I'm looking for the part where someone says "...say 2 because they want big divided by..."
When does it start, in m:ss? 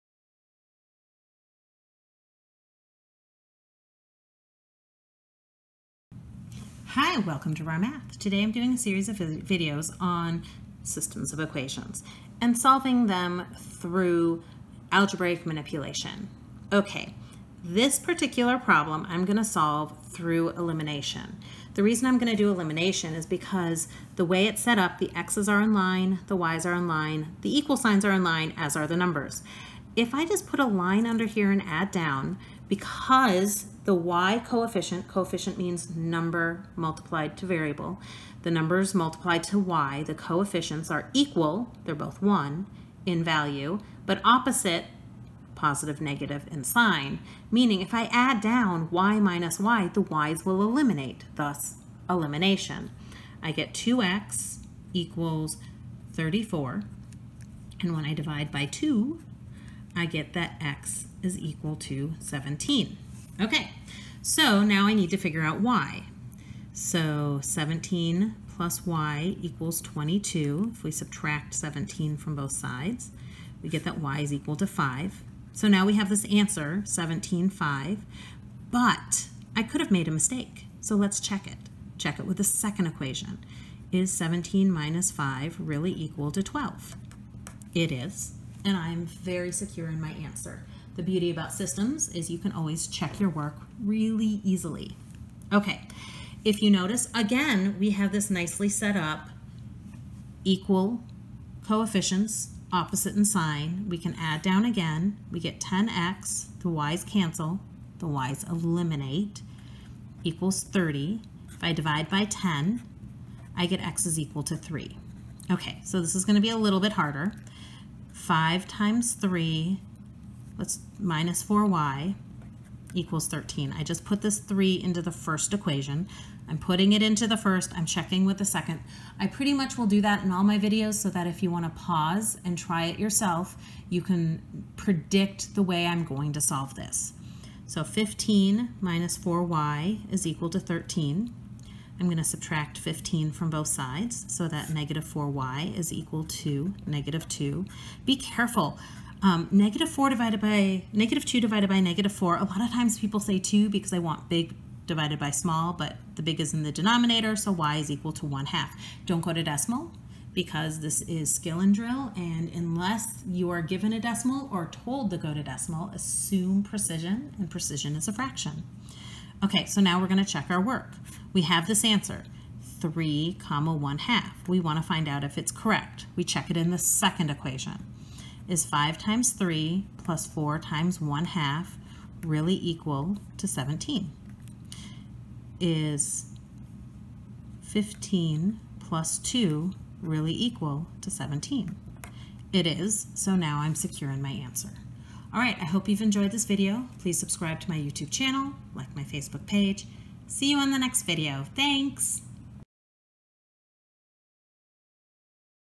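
2:33.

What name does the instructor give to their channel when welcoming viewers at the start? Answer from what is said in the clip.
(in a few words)
Rahr Math.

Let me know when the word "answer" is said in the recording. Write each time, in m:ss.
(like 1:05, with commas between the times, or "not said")
1:16, 1:30, 2:51, 3:14.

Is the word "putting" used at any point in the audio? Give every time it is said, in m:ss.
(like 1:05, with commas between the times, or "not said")
2:06.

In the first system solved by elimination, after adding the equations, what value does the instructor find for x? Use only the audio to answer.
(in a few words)
17.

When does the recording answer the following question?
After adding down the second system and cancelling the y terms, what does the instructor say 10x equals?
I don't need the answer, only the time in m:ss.
1:50.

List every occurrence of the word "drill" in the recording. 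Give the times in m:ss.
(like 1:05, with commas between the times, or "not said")
2:41.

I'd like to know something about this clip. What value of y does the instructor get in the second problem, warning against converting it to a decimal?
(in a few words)
1/2.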